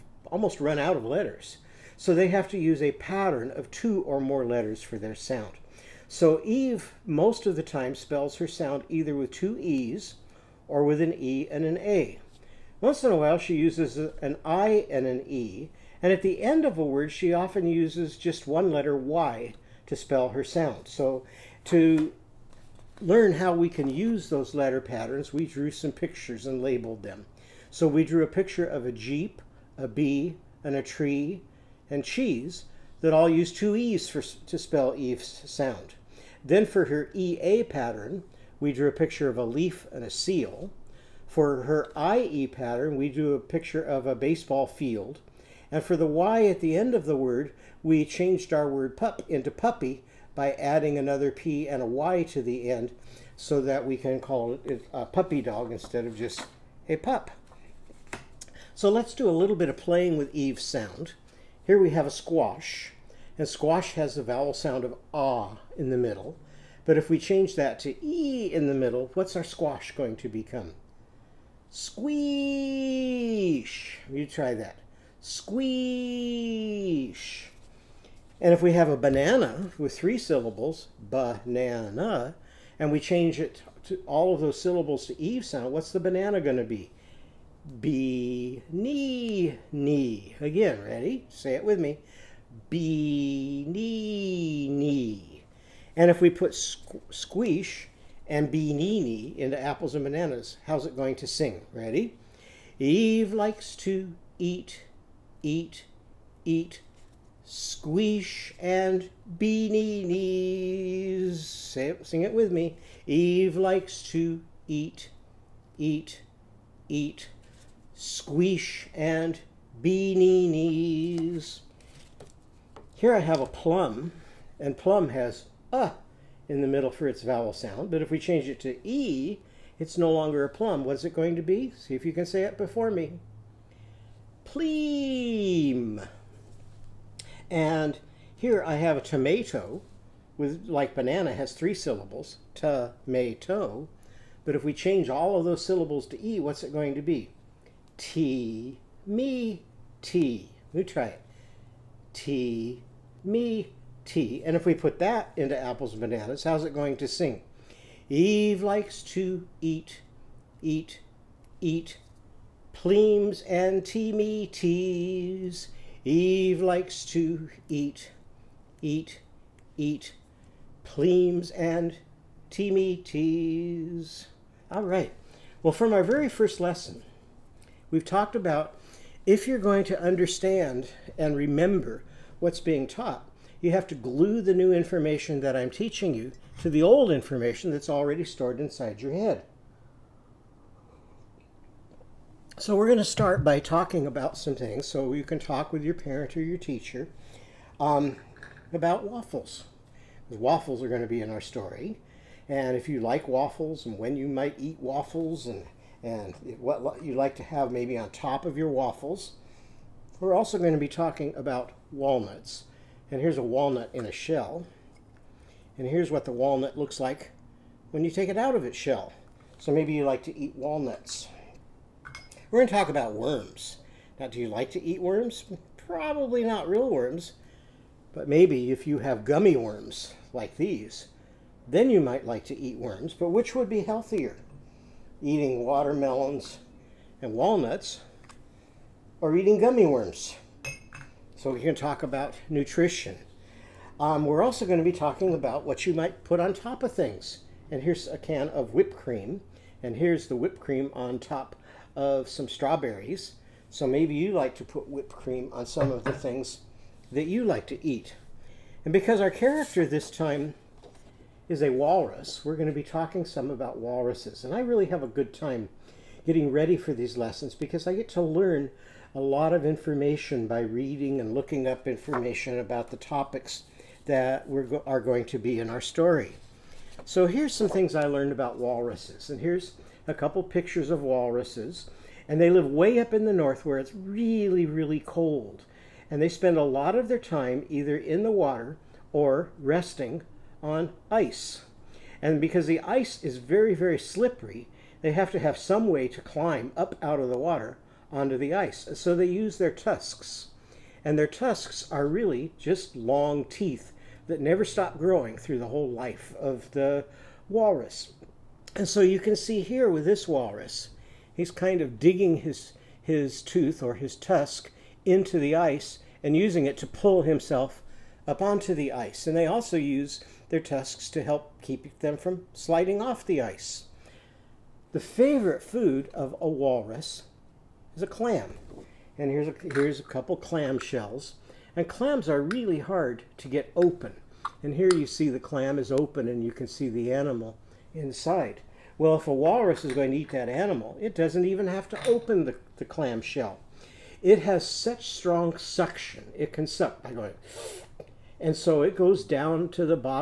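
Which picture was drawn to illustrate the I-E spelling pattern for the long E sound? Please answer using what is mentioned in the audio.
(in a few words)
baseball field.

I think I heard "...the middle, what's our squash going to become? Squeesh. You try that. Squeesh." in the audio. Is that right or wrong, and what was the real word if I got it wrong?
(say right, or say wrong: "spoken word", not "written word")
right.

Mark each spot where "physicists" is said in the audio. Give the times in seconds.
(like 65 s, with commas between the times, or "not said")
not said.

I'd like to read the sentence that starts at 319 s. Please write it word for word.
And they also use their tusks to help keep them from sliding off the ice.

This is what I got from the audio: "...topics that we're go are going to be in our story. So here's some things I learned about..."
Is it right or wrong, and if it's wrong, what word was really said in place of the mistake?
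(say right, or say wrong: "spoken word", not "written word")
right.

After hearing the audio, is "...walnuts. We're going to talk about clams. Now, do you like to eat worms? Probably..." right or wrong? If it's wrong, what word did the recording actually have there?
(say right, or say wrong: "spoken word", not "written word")
wrong: "worms", not "clams".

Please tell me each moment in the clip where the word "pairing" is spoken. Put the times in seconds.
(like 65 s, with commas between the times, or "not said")
not said.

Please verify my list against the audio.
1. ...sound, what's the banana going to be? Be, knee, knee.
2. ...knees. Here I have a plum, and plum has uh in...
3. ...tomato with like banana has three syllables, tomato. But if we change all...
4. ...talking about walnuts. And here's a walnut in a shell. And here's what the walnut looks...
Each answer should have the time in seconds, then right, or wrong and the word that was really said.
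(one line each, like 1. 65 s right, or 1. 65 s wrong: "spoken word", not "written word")
1. 85 s right
2. 120 s right
3. 139 s right
4. 210 s right.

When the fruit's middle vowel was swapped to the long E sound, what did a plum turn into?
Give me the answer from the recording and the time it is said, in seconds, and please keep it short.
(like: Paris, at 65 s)
Pleem, at 134 s.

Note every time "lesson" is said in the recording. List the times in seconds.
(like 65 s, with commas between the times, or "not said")
176 s, 267 s.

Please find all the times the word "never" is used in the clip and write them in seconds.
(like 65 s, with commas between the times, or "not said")
304 s.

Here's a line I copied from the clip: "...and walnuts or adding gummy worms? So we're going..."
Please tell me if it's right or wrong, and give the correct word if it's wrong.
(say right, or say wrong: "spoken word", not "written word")
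wrong: "eating", not "adding".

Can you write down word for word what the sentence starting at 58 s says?
So let's do a little bit of playing with Eve's sound.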